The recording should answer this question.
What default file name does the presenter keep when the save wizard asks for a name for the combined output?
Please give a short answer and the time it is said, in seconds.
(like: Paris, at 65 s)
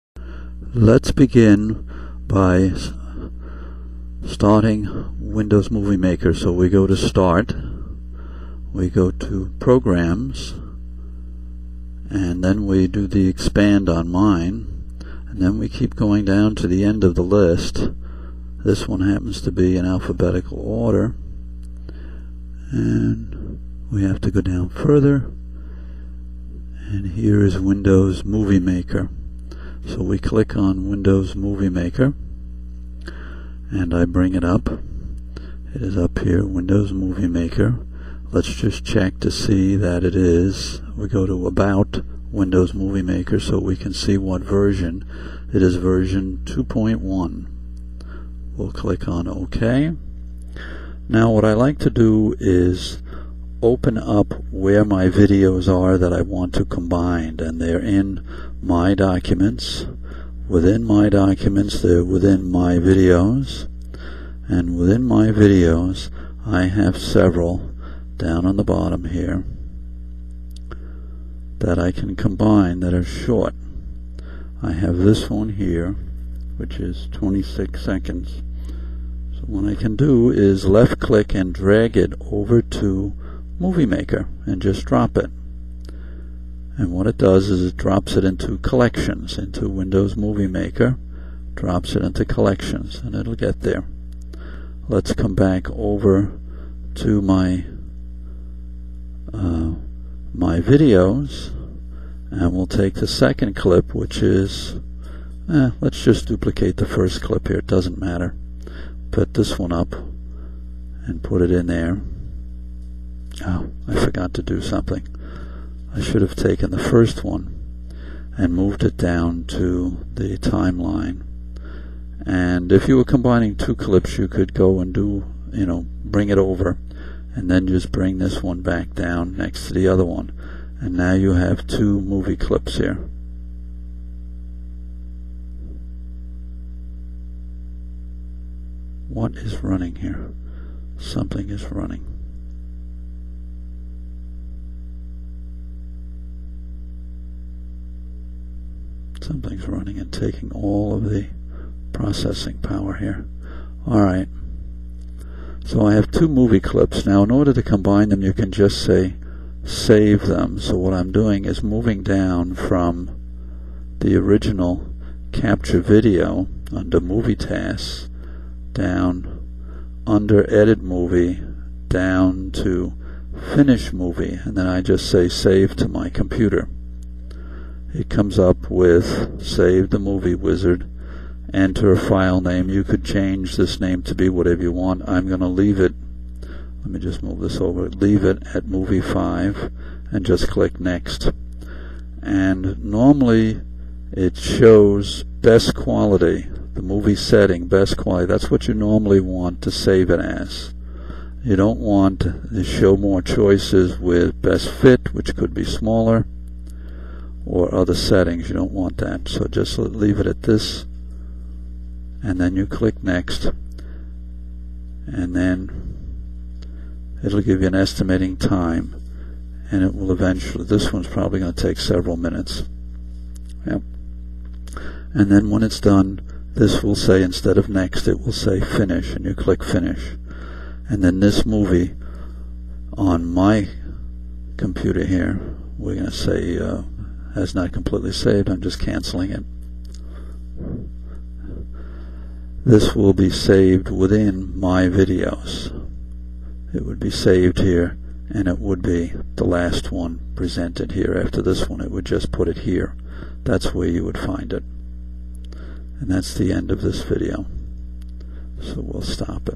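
movie 5, at 188 s.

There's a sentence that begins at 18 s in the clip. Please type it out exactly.
This one happens to be in alphabetical order, and we have to go down further, and here is Windows Movie Maker.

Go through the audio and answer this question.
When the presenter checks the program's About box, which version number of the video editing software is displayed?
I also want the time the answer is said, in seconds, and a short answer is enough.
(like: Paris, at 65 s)
2.1, at 45 s.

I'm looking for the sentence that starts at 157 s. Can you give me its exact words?
In order to combine them, you can just say save them.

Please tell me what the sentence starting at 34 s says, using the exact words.
It is up here, Windows Movie Maker.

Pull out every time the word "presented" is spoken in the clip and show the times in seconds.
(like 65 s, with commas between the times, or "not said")
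250 s.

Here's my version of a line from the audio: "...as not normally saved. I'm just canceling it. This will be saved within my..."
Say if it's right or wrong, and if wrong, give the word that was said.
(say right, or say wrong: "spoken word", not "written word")
wrong: "completely", not "normally".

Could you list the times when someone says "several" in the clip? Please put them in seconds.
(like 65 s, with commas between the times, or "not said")
66 s, 221 s.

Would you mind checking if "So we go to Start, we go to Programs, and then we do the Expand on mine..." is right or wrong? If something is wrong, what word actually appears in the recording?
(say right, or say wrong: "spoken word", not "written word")
right.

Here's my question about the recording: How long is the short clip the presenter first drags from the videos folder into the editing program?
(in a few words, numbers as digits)
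26 seconds.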